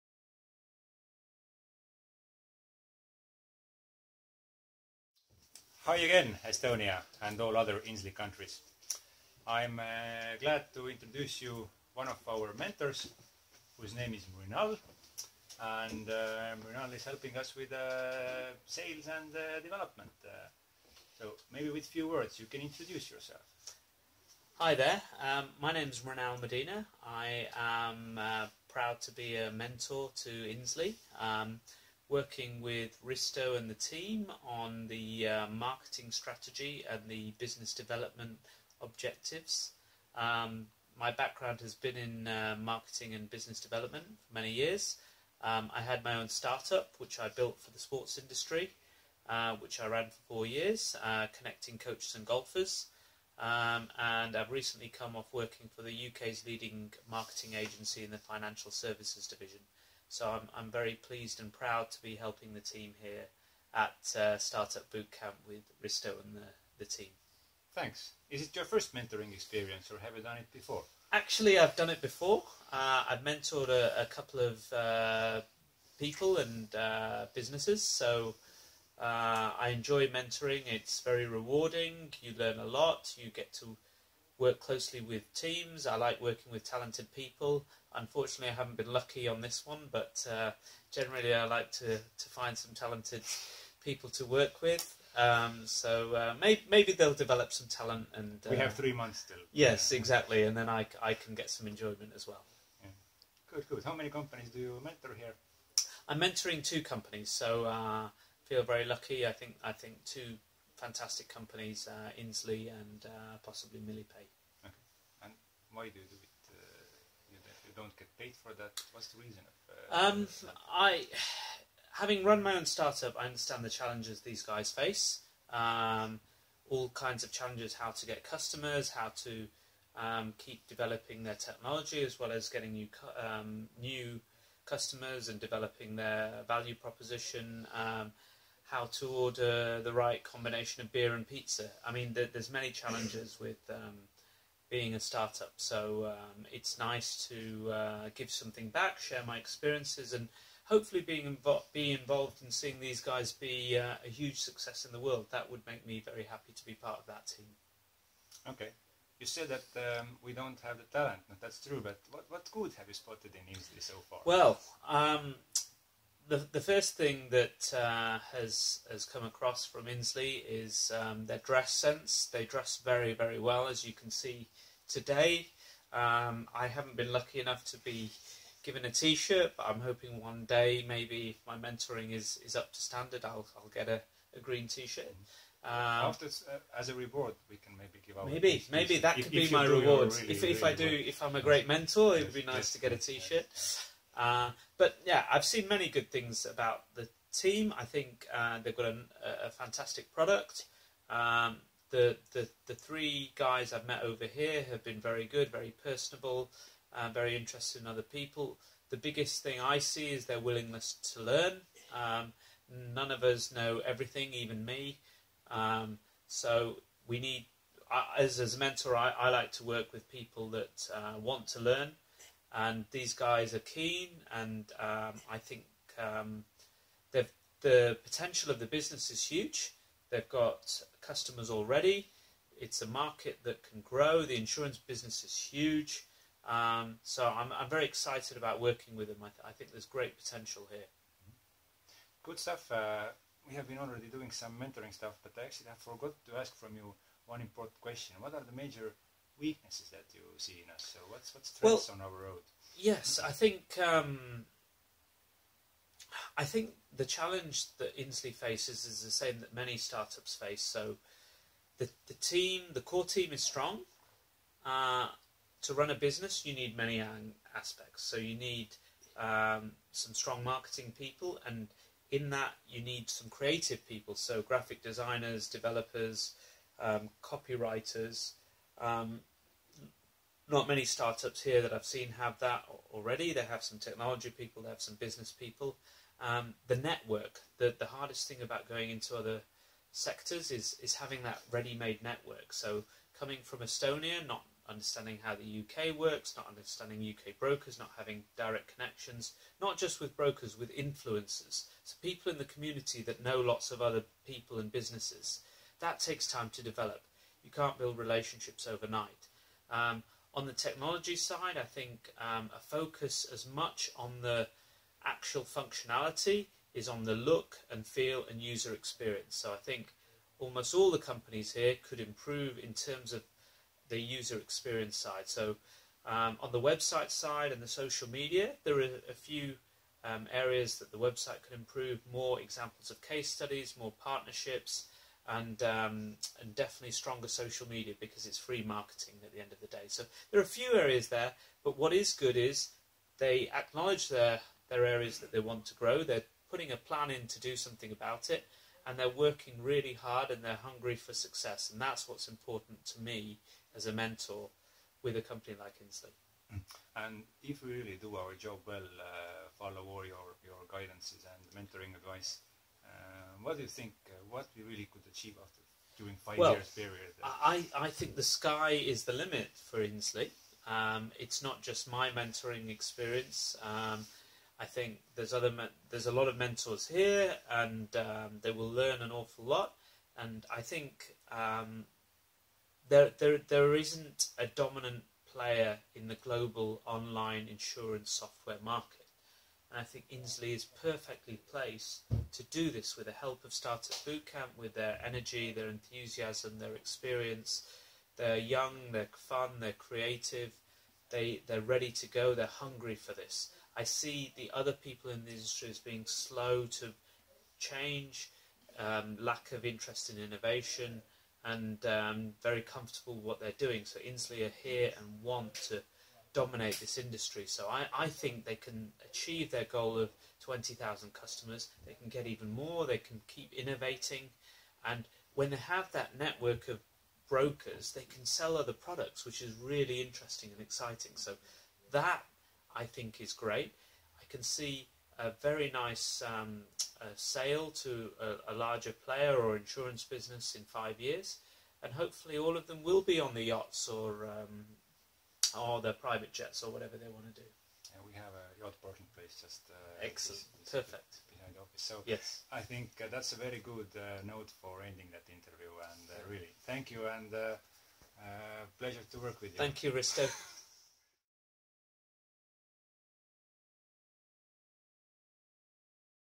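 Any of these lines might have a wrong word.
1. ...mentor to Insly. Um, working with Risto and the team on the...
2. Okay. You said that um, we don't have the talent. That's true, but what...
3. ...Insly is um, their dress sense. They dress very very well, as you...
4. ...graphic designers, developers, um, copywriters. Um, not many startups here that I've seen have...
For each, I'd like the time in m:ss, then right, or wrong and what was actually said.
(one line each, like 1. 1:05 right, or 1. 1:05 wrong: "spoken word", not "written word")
1. 0:29 right
2. 2:38 right
3. 2:49 right
4. 4:34 right.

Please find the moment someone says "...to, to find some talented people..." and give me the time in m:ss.
1:31.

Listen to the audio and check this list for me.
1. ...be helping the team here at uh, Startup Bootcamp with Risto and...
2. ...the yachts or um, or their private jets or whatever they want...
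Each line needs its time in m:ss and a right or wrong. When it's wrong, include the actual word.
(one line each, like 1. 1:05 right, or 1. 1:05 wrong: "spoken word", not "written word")
1. 1:02 right
2. 7:23 right.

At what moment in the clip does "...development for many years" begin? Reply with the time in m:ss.
0:43.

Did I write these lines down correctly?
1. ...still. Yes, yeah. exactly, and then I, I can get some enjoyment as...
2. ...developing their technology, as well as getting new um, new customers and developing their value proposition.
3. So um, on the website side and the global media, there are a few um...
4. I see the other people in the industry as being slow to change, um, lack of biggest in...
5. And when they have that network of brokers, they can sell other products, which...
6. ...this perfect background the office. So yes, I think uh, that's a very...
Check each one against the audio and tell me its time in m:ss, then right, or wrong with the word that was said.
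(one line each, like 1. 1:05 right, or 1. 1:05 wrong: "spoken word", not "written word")
1. 1:39 right
2. 2:10 right
3. 5:25 wrong: "social", not "global"
4. 6:43 wrong: "interest", not "biggest"
5. 7:04 right
6. 7:30 wrong: "behind", not "background".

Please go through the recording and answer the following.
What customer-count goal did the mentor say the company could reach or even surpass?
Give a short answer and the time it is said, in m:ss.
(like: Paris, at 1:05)
20,000, at 7:00.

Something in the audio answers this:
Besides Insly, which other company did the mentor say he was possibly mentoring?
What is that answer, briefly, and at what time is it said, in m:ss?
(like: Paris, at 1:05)
Millipay, at 1:53.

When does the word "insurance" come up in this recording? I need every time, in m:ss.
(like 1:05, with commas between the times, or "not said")
3:54, 6:27, 7:19.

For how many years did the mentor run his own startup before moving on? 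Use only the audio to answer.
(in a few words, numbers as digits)
4.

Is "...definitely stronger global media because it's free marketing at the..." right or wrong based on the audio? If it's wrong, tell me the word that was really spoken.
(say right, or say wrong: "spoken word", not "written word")
wrong: "social", not "global".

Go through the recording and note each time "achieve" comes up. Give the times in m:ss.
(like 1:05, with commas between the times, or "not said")
6:05, 6:59.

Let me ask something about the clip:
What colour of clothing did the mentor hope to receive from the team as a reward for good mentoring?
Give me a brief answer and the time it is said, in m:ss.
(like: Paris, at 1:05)
Green, at 3:04.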